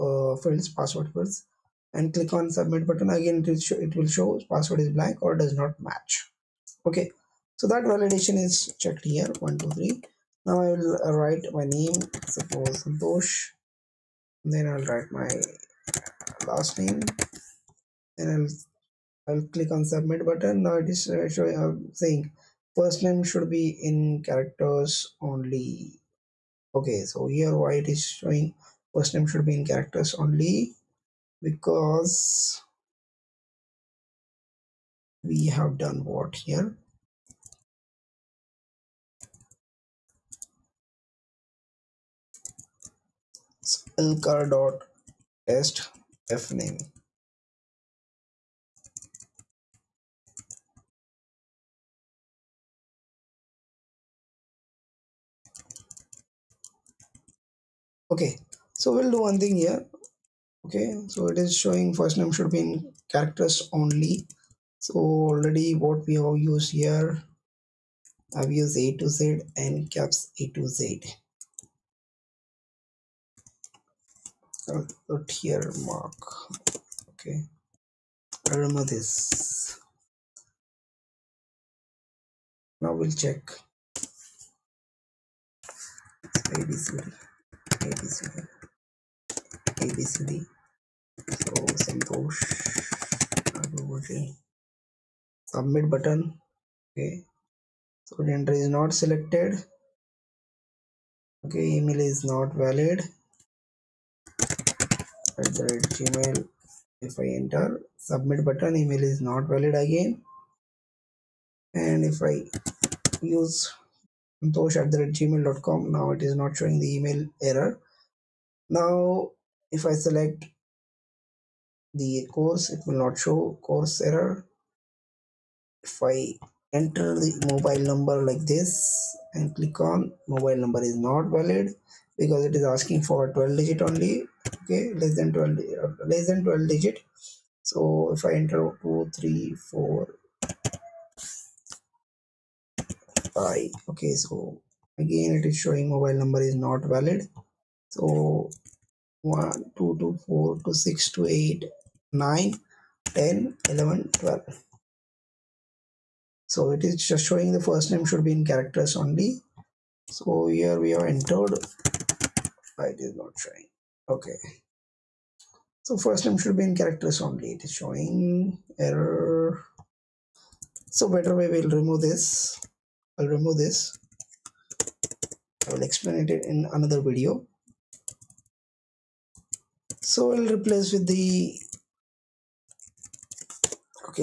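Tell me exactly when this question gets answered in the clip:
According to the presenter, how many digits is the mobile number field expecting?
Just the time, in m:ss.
2:13.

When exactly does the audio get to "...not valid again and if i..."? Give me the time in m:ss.
1:49.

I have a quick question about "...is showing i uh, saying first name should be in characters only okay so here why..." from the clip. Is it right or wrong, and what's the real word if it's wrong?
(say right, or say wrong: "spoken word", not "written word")
right.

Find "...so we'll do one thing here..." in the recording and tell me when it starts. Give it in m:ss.
0:58.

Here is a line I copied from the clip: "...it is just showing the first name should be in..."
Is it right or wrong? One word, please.
right.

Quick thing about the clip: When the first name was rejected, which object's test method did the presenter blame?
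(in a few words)
lcar.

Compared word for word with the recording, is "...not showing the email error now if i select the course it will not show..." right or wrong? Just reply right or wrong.
right.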